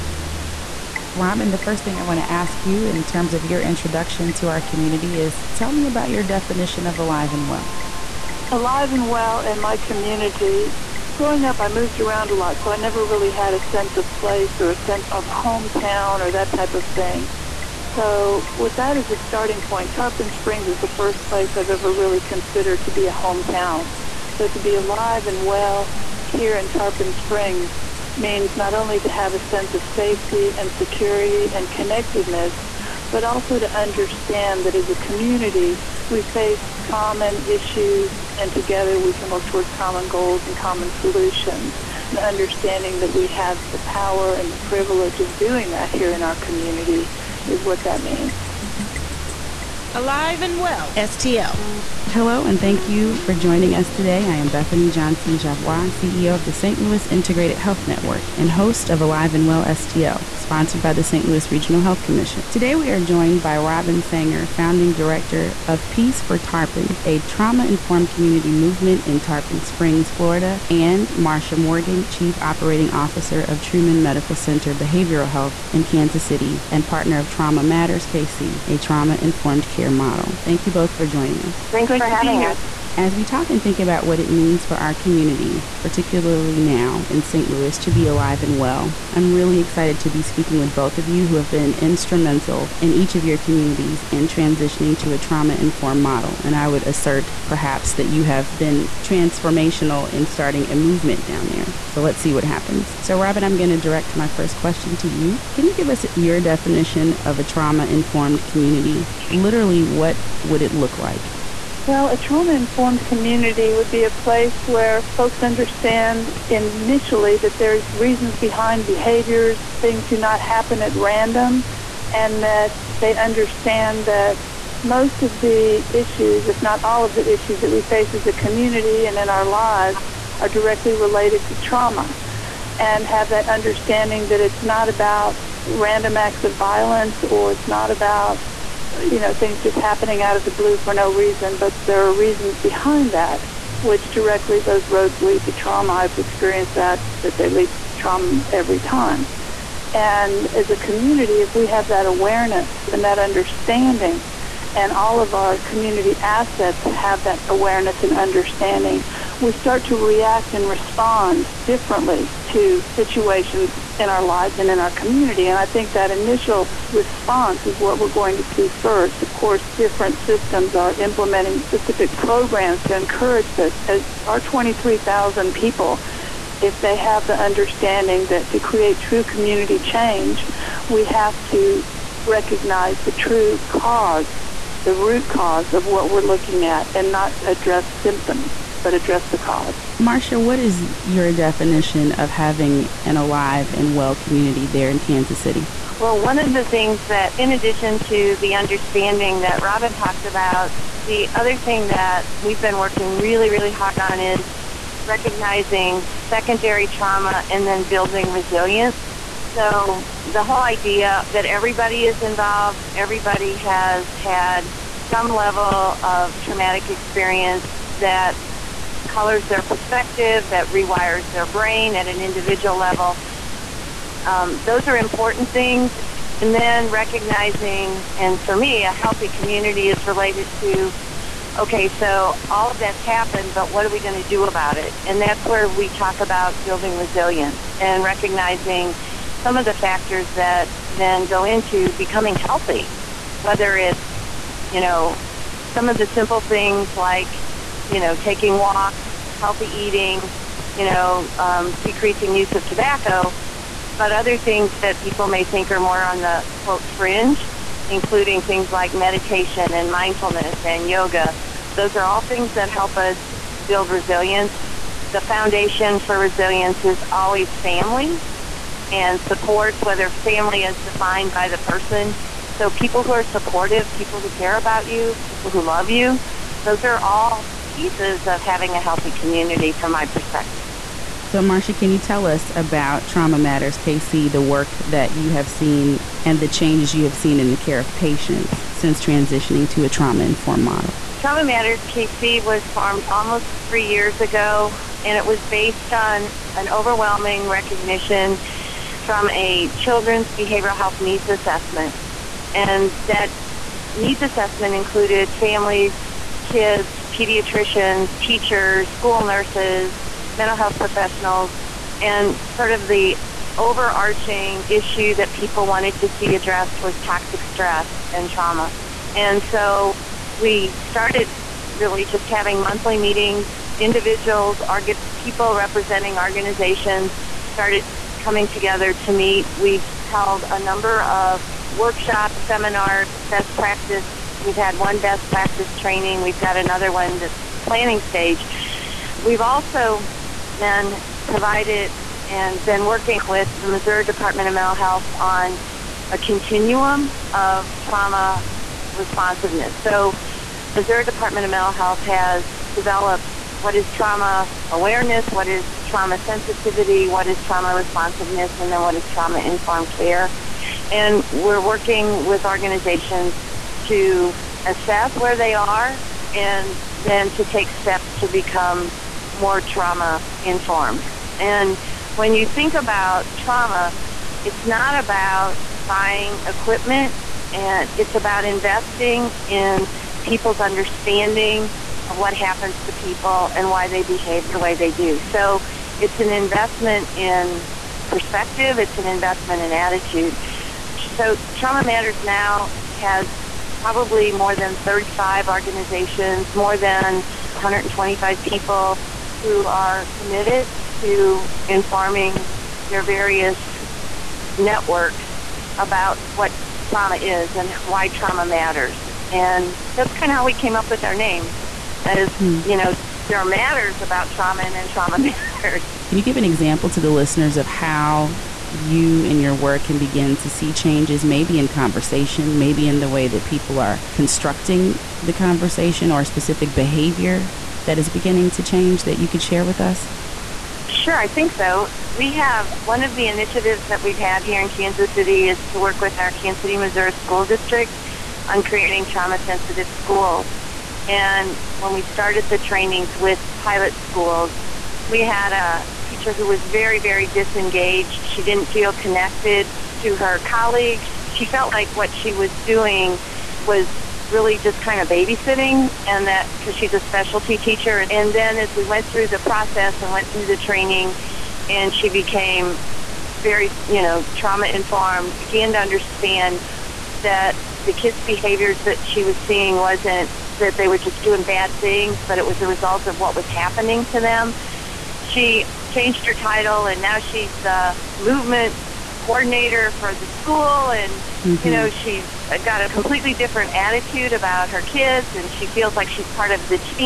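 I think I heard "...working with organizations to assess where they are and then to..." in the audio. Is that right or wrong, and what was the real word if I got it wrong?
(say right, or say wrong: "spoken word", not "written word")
right.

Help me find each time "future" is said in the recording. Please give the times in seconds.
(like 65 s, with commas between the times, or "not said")
not said.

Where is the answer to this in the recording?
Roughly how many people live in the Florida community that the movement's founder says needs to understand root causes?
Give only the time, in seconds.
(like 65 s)
174 s.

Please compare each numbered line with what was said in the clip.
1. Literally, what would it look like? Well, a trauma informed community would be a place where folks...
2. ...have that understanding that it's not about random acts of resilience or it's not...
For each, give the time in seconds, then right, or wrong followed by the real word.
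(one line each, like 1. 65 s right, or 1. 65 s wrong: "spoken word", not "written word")
1. 109 s right
2. 133 s wrong: "violence", not "resilience".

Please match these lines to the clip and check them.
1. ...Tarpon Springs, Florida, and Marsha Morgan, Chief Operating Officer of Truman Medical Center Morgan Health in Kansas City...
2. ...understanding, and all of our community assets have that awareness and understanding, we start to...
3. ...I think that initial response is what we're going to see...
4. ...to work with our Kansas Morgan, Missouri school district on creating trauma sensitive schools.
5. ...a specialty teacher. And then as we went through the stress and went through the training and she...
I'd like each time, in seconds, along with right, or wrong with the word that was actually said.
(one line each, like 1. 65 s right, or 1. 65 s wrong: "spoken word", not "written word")
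1. 69 s wrong: "Behavioral", not "Morgan"
2. 153 s right
3. 165 s right
4. 435 s wrong: "City", not "Morgan"
5. 456 s wrong: "process", not "stress".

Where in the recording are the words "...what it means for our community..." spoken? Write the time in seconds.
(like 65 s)
84 s.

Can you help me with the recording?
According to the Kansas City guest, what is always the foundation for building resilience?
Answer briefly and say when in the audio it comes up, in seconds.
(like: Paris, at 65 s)
family and supports, at 267 s.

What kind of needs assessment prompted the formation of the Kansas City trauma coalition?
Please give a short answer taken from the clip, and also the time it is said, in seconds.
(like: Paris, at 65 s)
children's behavioral health, at 299 s.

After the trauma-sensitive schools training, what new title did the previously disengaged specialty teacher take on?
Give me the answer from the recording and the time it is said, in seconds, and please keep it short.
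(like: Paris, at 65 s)
movement coordinator, at 478 s.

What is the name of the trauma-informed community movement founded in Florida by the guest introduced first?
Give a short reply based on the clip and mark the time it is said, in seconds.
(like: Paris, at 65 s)
Peace4Tarpon, at 65 s.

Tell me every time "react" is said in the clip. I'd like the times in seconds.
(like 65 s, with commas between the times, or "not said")
159 s.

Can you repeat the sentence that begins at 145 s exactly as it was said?
I've experienced that, that they lead to trauma every time.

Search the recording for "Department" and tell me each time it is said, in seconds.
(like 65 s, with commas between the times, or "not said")
344 s, 351 s.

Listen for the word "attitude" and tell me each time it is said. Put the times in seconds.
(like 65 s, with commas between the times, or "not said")
389 s, 483 s.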